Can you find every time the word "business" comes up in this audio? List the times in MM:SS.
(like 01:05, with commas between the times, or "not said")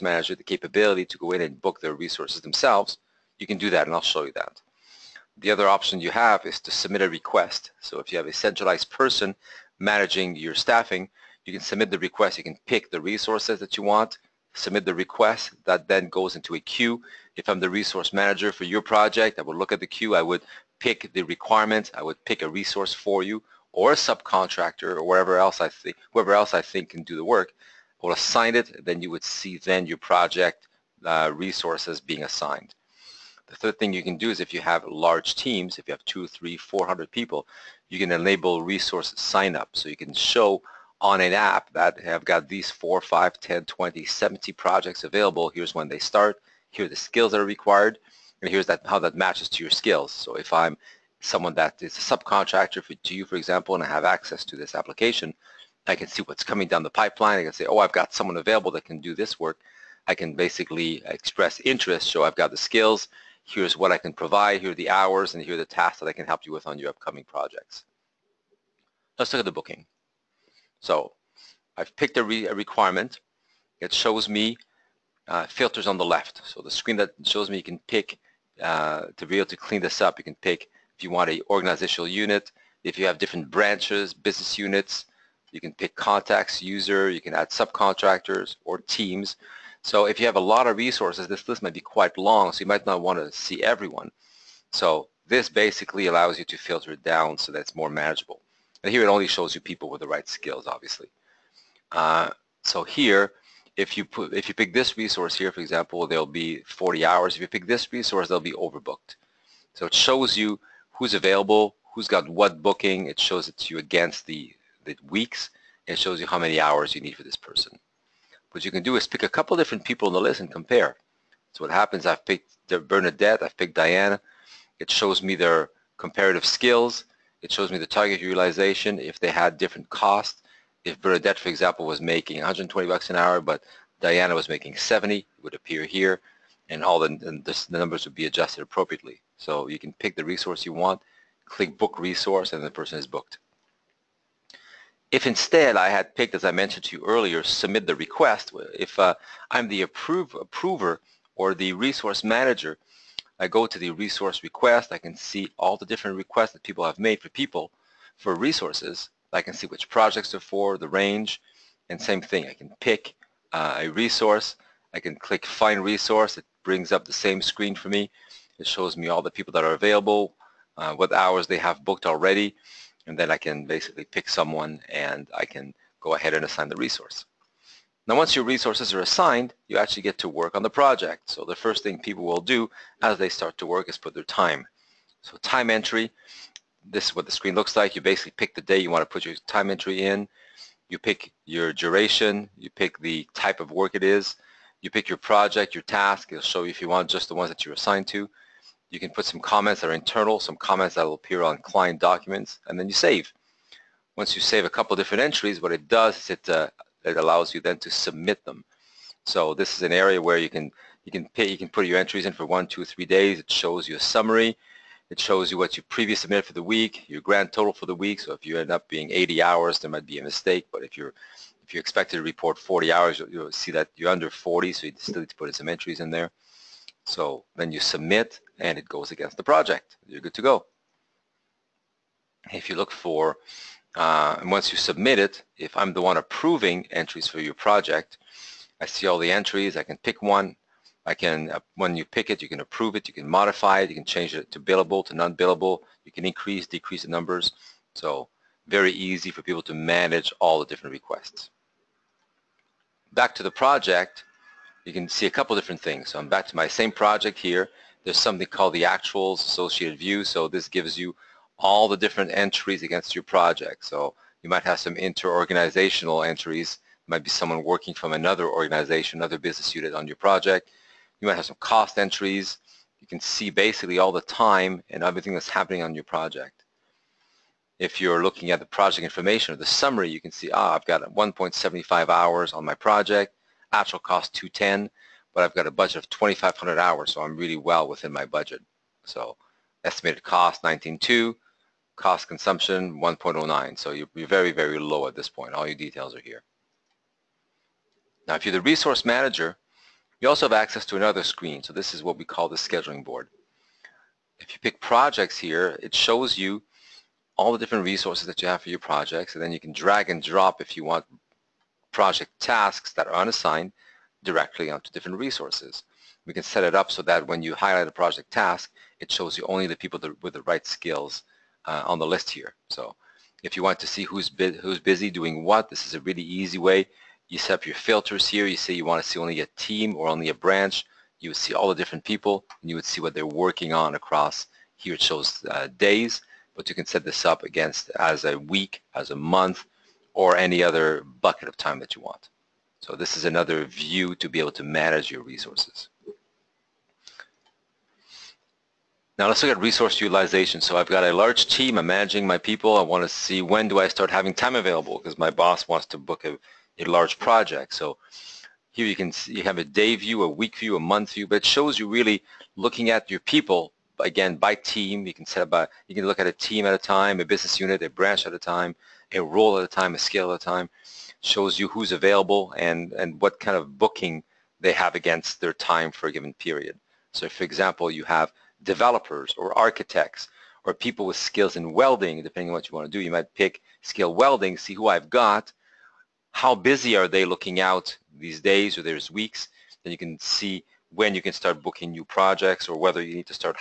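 01:24, 04:29, 06:07.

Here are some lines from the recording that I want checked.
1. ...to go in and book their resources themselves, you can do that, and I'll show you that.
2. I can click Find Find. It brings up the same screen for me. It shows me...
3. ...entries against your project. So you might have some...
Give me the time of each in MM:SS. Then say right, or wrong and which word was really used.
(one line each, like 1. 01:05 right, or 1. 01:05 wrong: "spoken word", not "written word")
1. 00:01 right
2. 02:44 wrong: "Resource", not "Find"
3. 04:22 right.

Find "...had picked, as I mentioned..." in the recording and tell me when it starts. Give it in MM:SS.
02:25.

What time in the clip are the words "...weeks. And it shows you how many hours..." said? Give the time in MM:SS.
01:55.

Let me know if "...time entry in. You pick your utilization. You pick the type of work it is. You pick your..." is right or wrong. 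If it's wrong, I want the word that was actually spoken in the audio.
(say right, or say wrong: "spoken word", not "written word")
wrong: "duration", not "utilization".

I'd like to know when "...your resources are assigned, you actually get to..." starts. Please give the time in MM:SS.
02:58.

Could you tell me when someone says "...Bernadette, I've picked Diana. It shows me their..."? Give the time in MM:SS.
02:02.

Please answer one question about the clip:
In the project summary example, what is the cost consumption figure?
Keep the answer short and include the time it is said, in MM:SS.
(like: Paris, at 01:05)
1.09, at 04:53.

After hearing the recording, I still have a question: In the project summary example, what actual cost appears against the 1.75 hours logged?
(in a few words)
210.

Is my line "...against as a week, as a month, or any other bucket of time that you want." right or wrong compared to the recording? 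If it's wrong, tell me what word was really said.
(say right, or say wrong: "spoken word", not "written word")
right.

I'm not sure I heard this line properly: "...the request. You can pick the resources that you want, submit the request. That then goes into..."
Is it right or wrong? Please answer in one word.
right.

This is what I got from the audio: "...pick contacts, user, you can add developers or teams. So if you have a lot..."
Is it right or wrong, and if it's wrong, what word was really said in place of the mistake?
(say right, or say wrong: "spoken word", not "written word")
wrong: "subcontractors", not "developers".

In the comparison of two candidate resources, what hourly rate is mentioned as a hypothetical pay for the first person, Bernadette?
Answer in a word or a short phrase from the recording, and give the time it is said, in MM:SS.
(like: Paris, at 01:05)
$120, at 02:12.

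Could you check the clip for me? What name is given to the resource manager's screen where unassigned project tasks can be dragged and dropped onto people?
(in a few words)
scheduling board.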